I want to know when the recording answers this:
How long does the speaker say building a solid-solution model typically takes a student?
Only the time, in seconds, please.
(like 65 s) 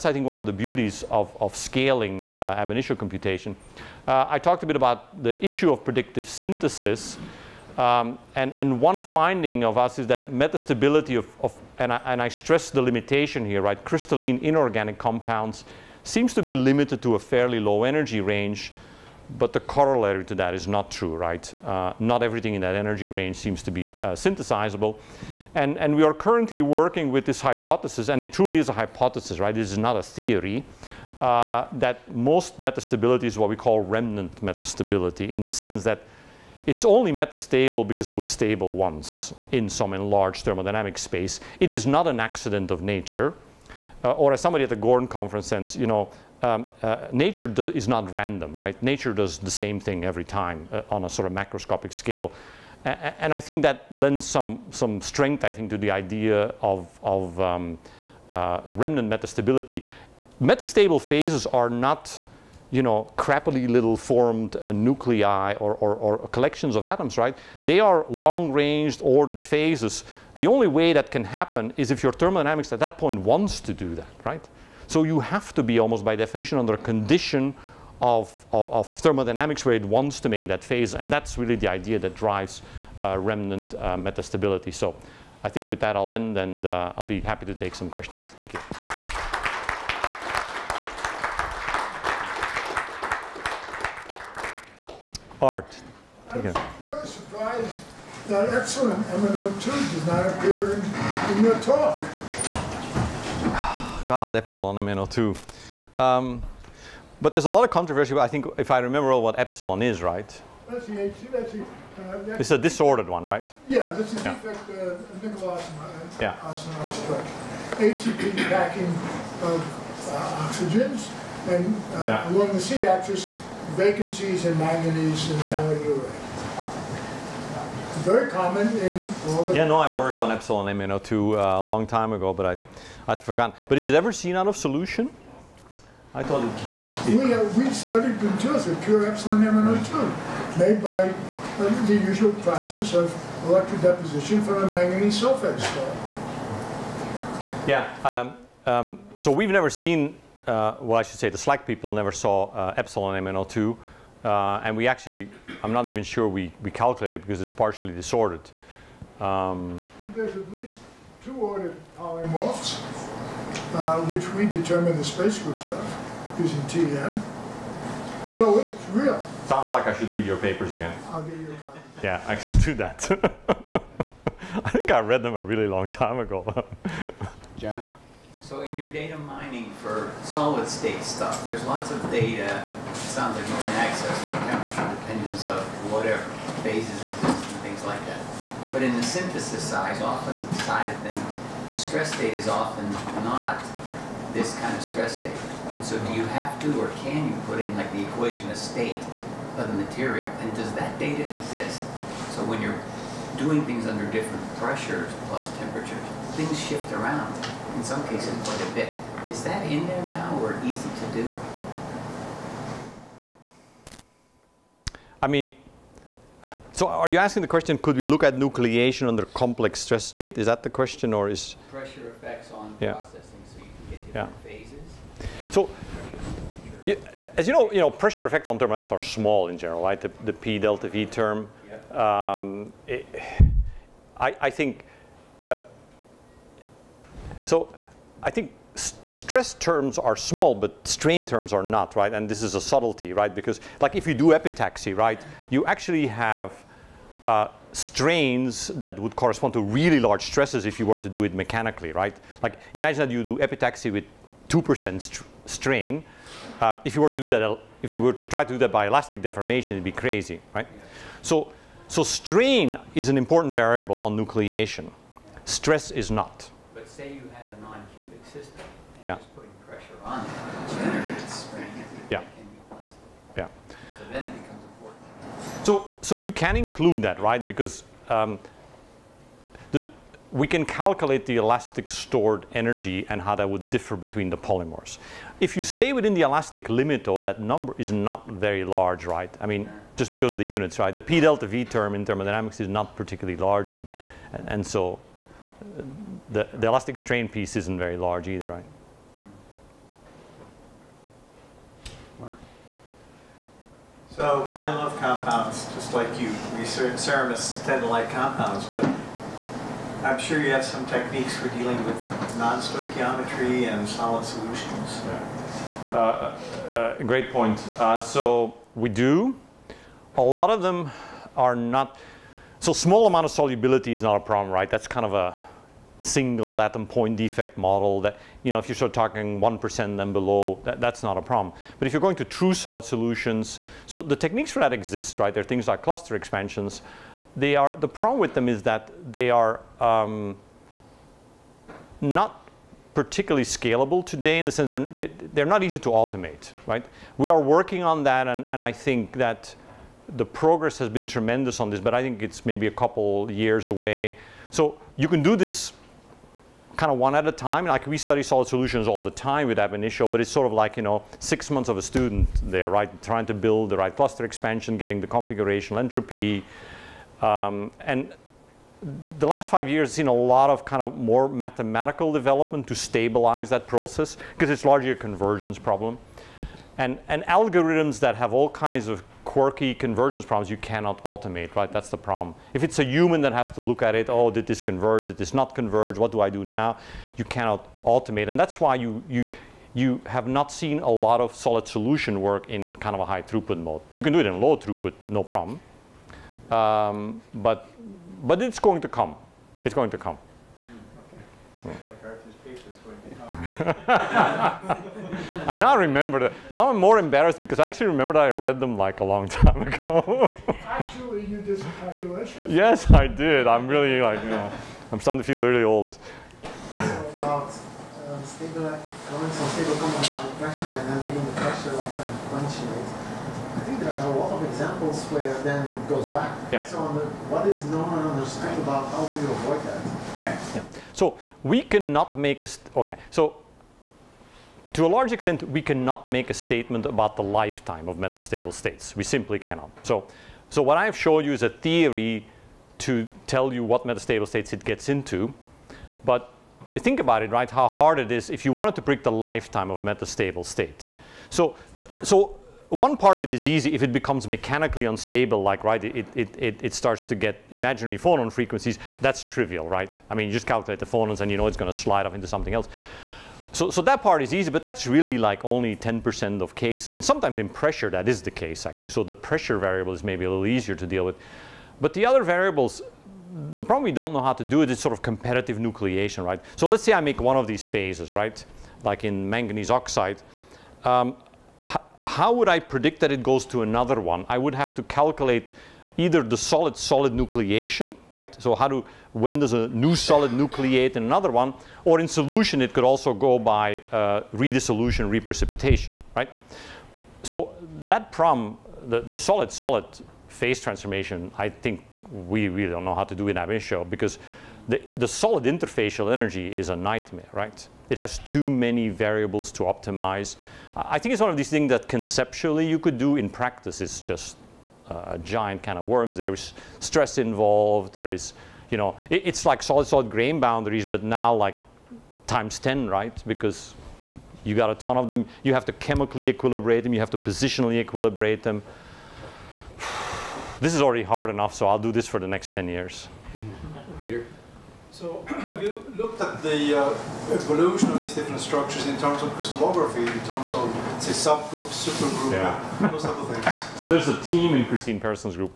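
361 s.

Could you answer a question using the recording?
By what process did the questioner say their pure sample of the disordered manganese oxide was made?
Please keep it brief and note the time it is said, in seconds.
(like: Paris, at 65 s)
electrodeposition, at 143 s.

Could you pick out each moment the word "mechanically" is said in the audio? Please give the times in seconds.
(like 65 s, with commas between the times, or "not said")
251 s, 454 s.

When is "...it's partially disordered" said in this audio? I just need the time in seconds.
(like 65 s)
157 s.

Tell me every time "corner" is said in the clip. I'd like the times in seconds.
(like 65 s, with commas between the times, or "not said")
not said.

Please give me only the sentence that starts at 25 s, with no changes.
And, and we are currently working with this hypothesis, and it truly is a hypothesis, right?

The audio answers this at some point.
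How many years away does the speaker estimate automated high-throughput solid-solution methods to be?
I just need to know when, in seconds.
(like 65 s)
352 s.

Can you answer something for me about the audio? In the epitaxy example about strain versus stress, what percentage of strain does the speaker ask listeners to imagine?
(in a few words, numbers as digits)
2%.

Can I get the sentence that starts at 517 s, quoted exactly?
There is, you know, it, it's like solid-solid grain boundaries, but now like times 10, right?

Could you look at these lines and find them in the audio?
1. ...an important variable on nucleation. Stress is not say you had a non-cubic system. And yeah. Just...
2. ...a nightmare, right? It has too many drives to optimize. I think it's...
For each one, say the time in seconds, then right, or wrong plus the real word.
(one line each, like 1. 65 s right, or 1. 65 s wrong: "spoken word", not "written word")
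1. 263 s right
2. 506 s wrong: "variables", not "drives".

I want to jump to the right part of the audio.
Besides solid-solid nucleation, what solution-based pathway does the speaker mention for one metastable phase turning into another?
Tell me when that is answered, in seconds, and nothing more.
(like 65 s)
494 s.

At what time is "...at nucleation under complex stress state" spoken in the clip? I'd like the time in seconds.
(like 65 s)
218 s.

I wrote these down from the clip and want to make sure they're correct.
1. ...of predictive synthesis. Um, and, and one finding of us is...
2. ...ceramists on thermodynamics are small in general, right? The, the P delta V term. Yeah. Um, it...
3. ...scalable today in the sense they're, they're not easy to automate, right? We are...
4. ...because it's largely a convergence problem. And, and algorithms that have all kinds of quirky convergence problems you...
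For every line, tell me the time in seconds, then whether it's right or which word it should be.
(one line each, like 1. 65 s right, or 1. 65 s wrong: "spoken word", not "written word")
1. 5 s right
2. 228 s wrong: "effects", not "ceramists"
3. 343 s right
4. 374 s right.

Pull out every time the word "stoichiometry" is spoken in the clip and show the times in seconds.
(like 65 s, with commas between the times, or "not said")
312 s.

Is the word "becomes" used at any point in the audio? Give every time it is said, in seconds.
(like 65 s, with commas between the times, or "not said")
274 s, 453 s.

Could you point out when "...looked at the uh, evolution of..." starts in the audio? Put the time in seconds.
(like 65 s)
535 s.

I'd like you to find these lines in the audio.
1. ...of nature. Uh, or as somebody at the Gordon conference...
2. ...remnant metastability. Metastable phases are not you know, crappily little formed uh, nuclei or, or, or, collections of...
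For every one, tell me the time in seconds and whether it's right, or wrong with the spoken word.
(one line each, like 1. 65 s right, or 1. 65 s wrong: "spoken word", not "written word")
1. 42 s right
2. 58 s right.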